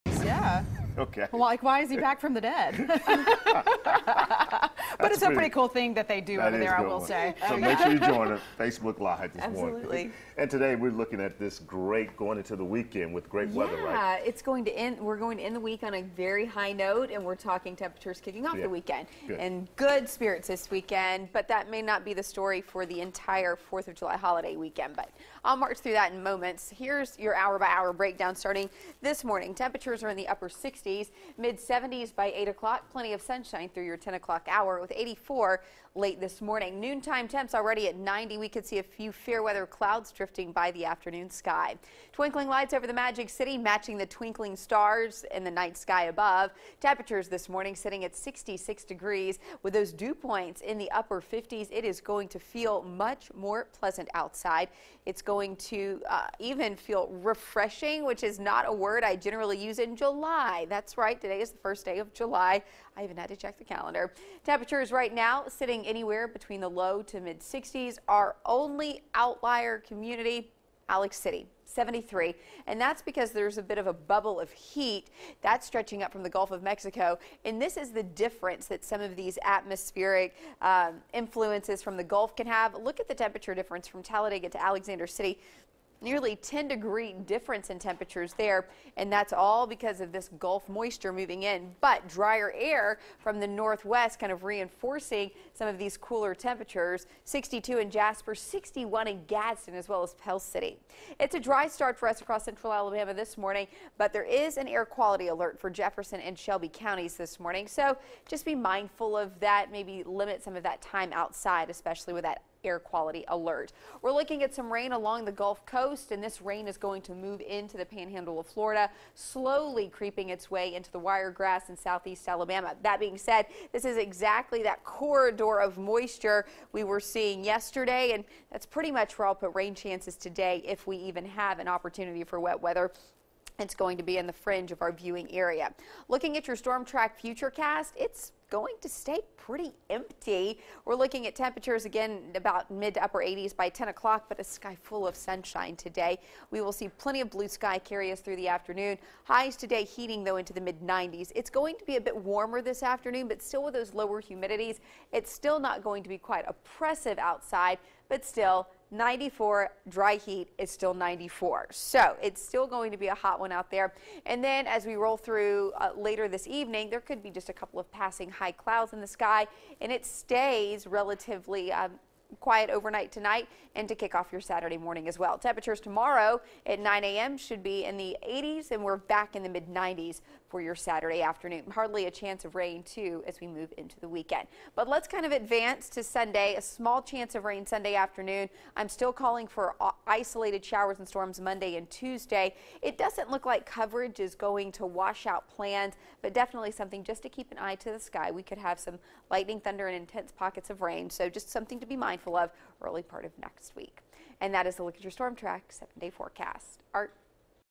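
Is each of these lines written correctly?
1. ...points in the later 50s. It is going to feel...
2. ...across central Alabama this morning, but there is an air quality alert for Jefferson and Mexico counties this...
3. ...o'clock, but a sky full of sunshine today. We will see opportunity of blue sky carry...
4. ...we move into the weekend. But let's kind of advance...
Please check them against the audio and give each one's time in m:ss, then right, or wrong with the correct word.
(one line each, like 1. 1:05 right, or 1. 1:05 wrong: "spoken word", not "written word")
1. 0:50 wrong: "upper", not "later"
2. 1:42 wrong: "Shelby", not "Mexico"
3. 2:23 wrong: "plenty", not "opportunity"
4. 3:03 right.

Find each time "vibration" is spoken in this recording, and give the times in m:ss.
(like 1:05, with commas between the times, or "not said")
not said.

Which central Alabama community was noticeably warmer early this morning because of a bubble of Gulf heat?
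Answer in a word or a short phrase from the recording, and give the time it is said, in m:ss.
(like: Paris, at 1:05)
Alex City, at 1:10.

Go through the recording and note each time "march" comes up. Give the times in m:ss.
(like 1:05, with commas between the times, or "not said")
0:25.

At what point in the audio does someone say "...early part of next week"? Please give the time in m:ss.
3:22.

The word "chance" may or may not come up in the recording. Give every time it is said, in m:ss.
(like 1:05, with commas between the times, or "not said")
2:09, 3:02, 3:07.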